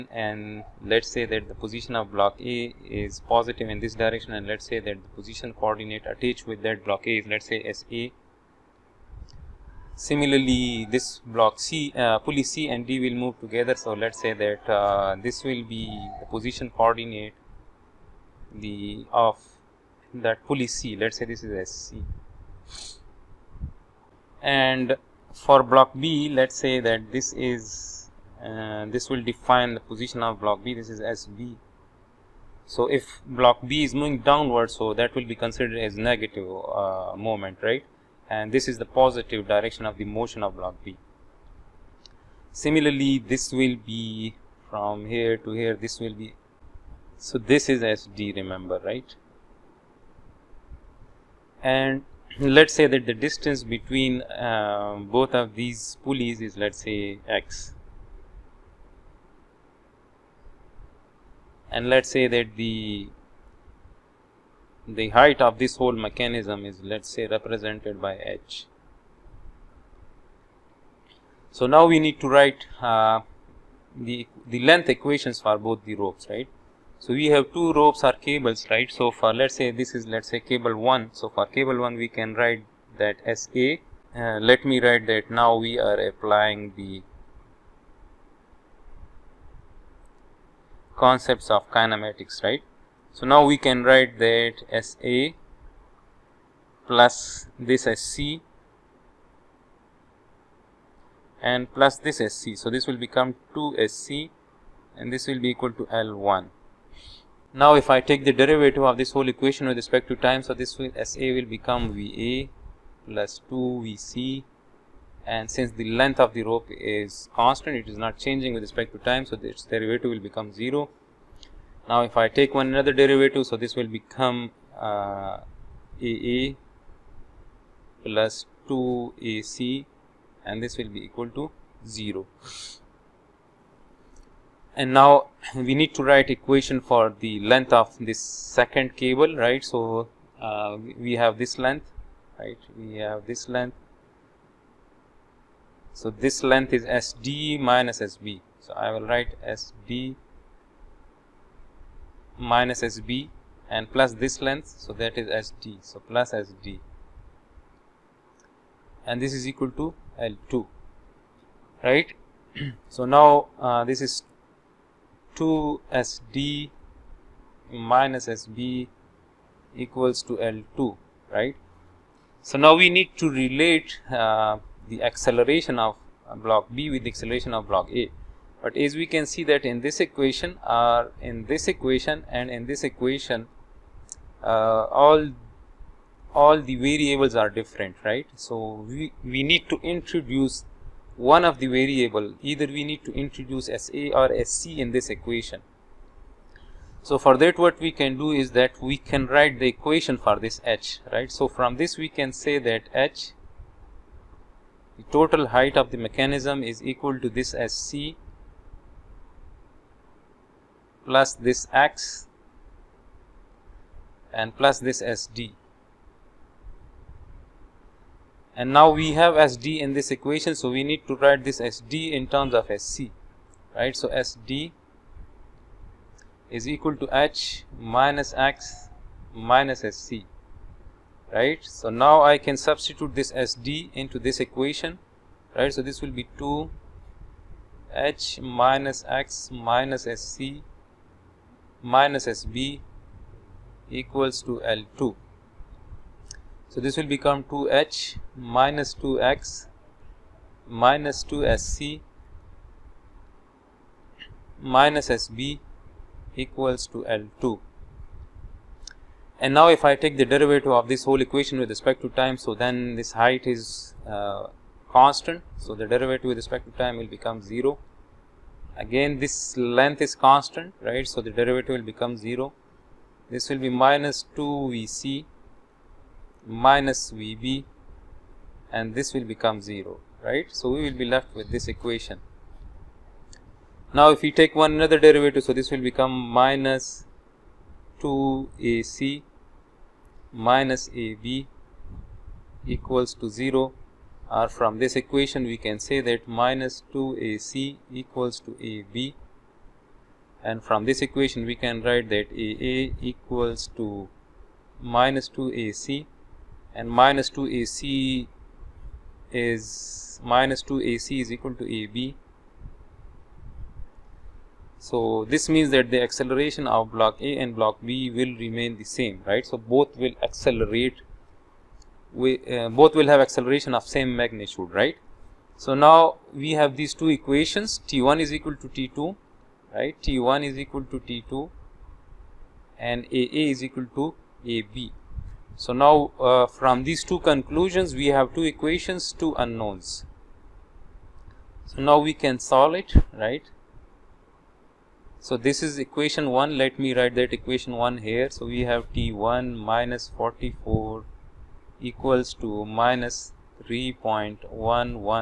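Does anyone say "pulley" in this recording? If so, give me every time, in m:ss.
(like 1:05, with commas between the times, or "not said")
0:12, 0:20, 0:56.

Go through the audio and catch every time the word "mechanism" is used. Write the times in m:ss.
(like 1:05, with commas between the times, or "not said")
1:05, 3:25.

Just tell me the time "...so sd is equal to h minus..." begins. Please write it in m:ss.
3:43.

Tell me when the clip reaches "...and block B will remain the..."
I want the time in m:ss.
5:17.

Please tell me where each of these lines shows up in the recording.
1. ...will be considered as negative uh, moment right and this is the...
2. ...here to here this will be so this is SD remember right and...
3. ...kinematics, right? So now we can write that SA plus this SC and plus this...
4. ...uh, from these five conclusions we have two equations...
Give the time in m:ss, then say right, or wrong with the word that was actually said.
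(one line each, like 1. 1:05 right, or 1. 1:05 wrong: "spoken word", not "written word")
1. 0:35 right
2. 0:45 right
3. 1:31 right
4. 5:36 wrong: "two", not "five".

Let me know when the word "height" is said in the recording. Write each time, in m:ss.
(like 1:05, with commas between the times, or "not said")
1:05, 3:25, 4:23.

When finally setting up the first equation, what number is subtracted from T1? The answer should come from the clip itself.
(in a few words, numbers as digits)
44.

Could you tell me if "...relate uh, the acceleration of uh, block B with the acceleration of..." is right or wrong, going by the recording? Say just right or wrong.
right.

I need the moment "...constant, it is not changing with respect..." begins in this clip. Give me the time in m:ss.
1:57.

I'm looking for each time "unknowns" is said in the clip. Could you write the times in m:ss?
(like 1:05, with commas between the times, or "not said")
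5:39.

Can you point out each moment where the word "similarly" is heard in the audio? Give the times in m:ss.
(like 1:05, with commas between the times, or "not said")
0:09, 0:42.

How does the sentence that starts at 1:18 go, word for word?
So for let's say this is let's say cable 1.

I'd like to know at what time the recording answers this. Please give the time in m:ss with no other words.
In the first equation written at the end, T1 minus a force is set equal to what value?
5:52.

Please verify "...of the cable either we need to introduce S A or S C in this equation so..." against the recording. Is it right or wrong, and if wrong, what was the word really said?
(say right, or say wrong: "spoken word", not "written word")
wrong: "variable", not "cable".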